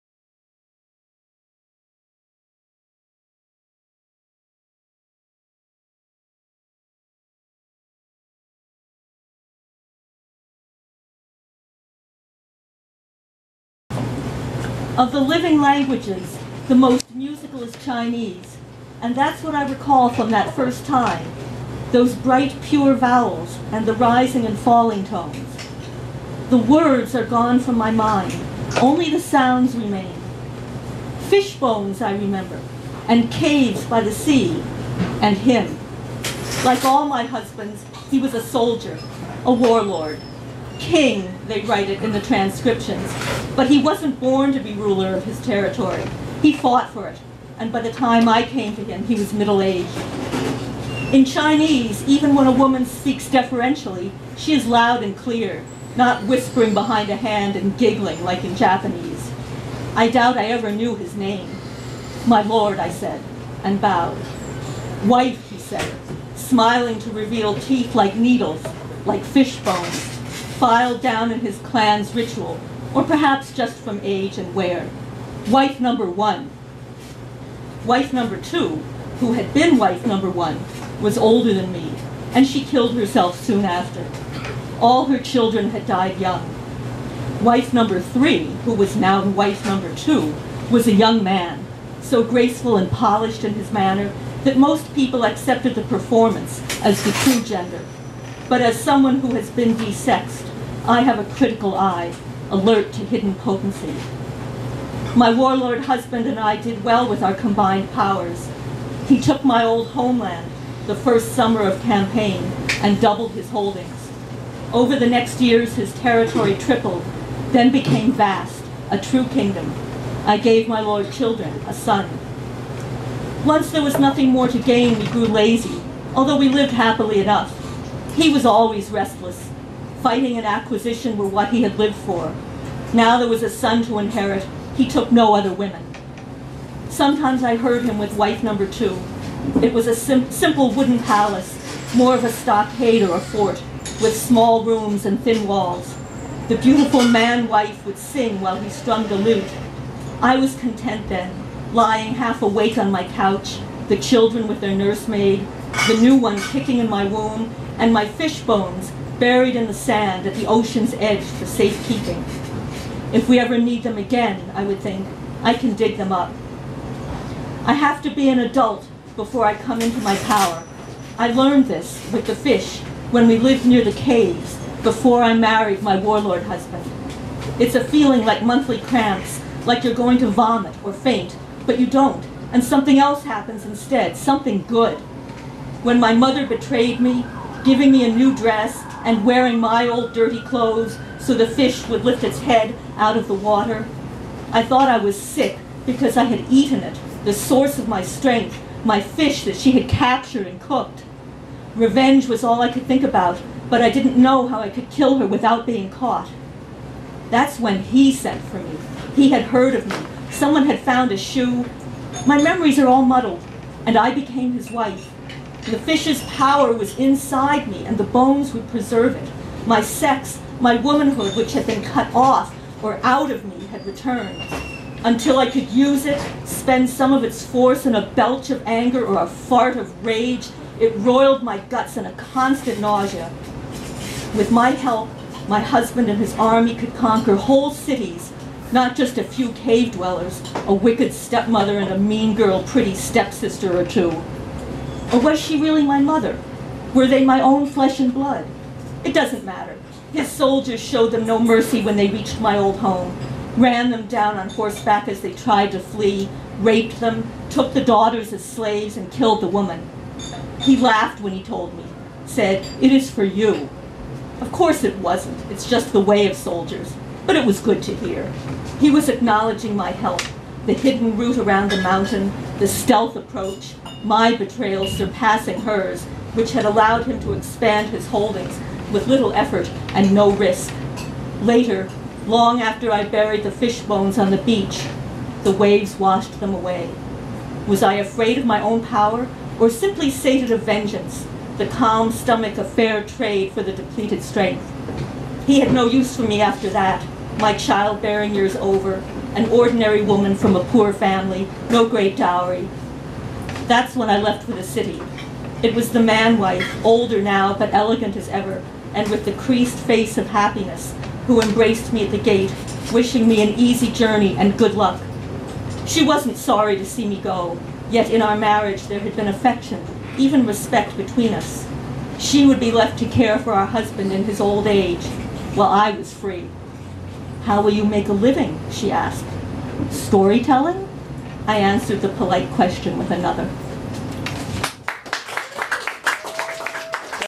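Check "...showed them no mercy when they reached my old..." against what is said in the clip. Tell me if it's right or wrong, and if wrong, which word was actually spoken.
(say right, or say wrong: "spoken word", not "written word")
right.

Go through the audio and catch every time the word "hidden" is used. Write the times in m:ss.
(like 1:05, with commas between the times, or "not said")
1:43, 4:30.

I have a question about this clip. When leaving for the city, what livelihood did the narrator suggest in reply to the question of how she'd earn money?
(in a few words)
Storytelling.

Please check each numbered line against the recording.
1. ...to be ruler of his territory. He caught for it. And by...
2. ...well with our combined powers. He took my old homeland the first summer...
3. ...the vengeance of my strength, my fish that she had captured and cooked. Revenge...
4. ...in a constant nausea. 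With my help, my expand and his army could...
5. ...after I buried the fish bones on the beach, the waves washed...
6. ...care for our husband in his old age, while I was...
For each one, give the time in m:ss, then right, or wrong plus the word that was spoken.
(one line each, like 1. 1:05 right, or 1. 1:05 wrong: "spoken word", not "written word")
1. 0:44 wrong: "fought", not "caught"
2. 1:46 right
3. 3:17 wrong: "source", not "vengeance"
4. 3:51 wrong: "husband", not "expand"
5. 4:42 right
6. 5:23 right.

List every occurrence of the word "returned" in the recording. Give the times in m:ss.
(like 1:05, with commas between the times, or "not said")
3:43.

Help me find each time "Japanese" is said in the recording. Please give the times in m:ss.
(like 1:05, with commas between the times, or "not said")
0:58.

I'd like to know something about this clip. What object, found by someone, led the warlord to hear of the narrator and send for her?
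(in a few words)
a shoe.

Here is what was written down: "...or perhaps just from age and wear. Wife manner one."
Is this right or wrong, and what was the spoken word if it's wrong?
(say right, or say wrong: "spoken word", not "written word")
wrong: "number", not "manner".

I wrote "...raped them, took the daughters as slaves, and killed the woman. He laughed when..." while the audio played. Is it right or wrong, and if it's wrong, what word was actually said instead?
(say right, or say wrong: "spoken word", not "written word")
right.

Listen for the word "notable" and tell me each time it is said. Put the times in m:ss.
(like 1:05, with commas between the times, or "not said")
not said.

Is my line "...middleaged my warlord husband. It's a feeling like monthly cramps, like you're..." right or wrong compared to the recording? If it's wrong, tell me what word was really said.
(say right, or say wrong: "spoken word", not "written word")
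wrong: "married", not "middleaged".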